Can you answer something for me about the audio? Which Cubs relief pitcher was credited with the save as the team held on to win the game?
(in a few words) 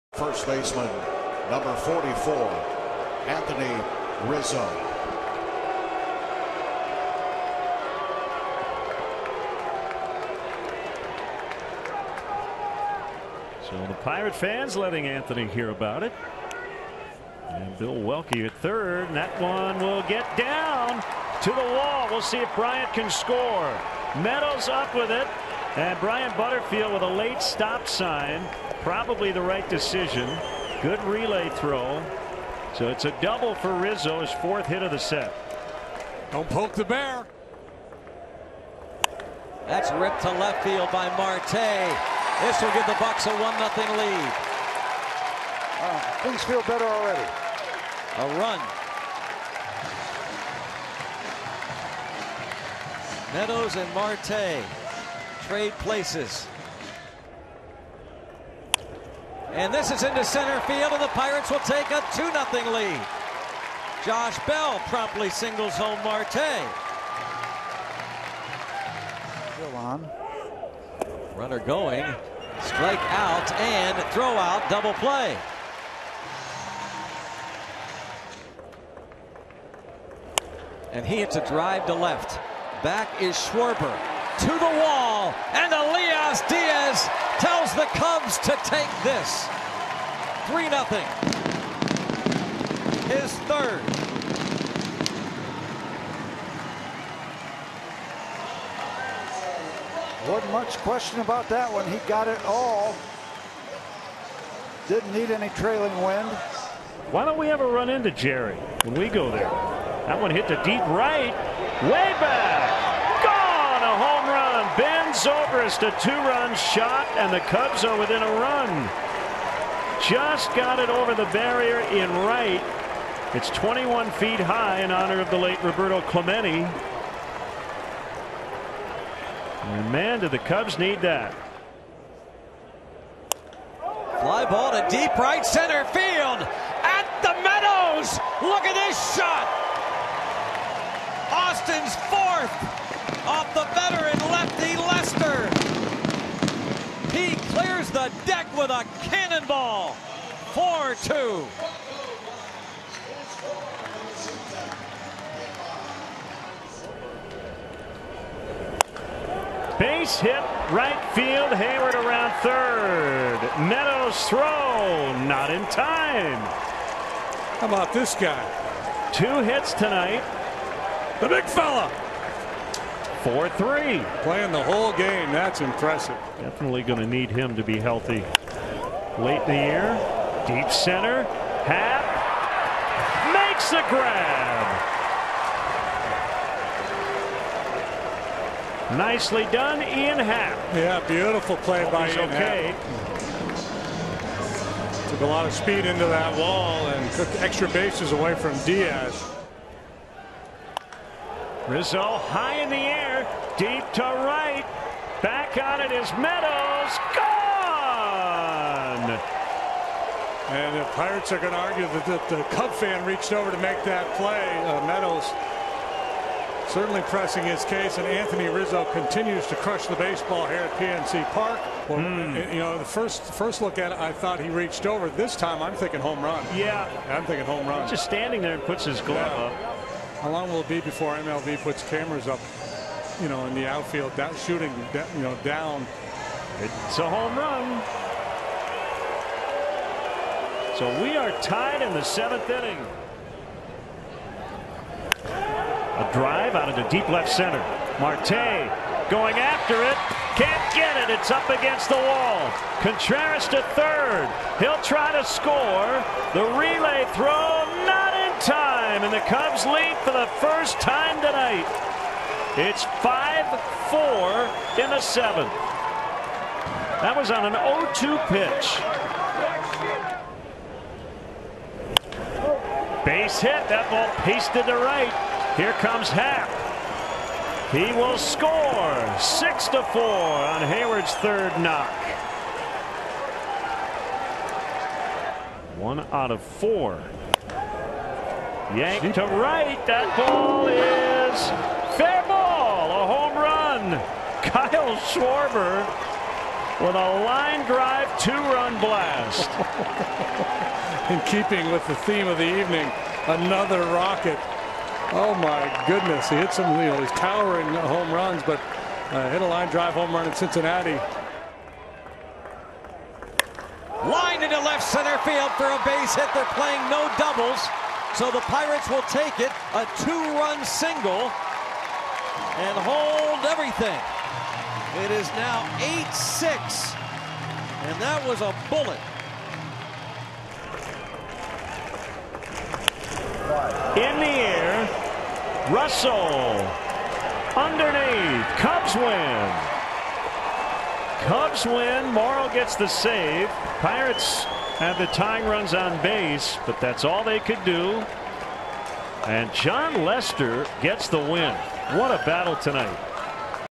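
Morrow.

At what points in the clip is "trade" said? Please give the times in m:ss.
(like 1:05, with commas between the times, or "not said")
0:55.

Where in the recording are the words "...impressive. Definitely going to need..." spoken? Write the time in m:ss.
2:55.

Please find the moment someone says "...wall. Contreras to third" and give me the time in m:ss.
4:11.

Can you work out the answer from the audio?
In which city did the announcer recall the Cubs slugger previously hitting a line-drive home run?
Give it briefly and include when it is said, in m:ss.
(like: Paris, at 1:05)
Cincinnati, at 5:10.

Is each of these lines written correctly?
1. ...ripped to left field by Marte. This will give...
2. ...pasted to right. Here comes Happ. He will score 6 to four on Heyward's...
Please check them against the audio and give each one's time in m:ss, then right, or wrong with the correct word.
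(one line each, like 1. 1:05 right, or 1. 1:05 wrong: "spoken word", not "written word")
1. 0:39 right
2. 4:34 right.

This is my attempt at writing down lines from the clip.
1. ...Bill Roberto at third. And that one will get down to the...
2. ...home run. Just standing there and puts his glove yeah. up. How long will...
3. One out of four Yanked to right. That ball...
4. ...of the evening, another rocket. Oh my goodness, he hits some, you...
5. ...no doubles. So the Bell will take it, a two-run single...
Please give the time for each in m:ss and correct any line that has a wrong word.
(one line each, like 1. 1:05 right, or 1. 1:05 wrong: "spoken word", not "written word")
1. 0:17 wrong: "Welke", not "Roberto"
2. 3:47 right
3. 4:45 right
4. 5:02 right
5. 5:16 wrong: "Pirates", not "Bell".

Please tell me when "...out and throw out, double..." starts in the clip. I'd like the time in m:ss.
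1:13.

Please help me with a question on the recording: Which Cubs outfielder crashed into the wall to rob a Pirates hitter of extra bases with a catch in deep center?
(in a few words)
Ian Happ.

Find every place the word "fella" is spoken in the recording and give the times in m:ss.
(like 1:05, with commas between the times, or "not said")
2:51.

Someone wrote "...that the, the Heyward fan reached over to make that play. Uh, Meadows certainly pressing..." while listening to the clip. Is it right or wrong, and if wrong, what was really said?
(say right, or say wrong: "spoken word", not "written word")
wrong: "Cub", not "Heyward".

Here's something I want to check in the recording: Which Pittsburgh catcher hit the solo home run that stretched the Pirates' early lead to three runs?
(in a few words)
Elias Diaz.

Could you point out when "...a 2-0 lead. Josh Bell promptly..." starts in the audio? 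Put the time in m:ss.
1:01.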